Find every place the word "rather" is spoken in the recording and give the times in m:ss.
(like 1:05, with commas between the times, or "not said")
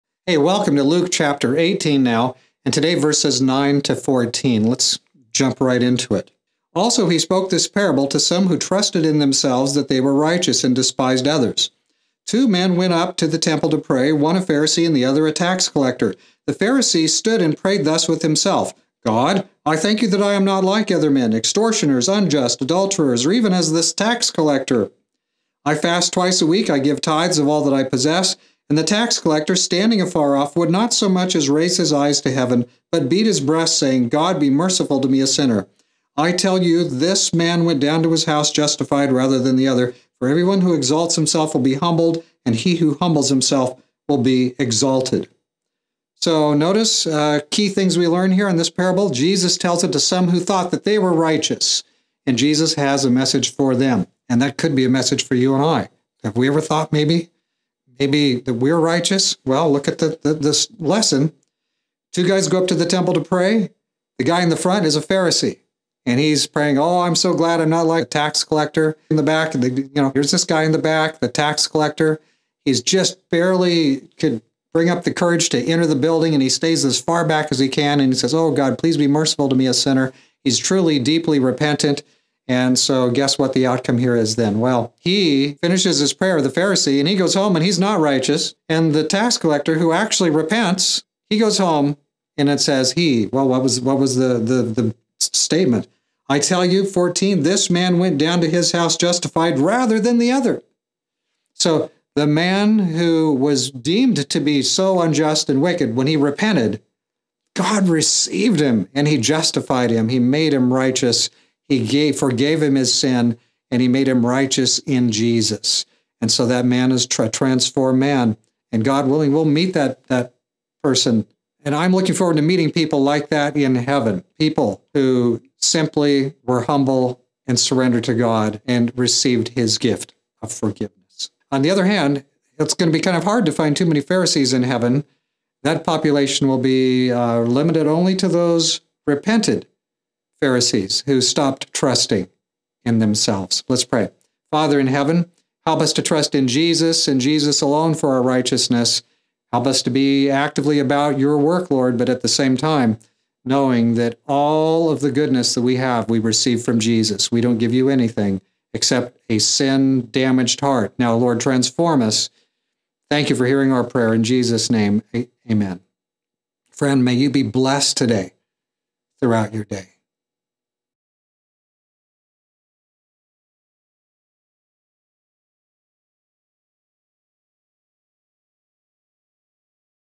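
0:39, 1:39.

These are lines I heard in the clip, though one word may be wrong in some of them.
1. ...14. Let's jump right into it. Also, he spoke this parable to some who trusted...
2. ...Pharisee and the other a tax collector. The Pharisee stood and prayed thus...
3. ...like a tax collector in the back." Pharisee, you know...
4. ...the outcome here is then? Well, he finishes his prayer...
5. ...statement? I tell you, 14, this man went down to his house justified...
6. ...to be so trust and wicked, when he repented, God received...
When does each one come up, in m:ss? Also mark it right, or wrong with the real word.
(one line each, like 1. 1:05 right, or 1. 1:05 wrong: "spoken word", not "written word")
1. 0:03 right
2. 0:14 right
3. 1:07 wrong: "The", not "Pharisee"
4. 1:23 right
5. 1:35 right
6. 1:44 wrong: "unjust", not "trust".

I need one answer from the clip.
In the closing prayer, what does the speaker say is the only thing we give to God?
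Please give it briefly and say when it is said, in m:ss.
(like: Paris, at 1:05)
A sin damaged heart, at 2:39.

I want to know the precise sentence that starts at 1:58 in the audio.
And God willing, we'll meet that, that person.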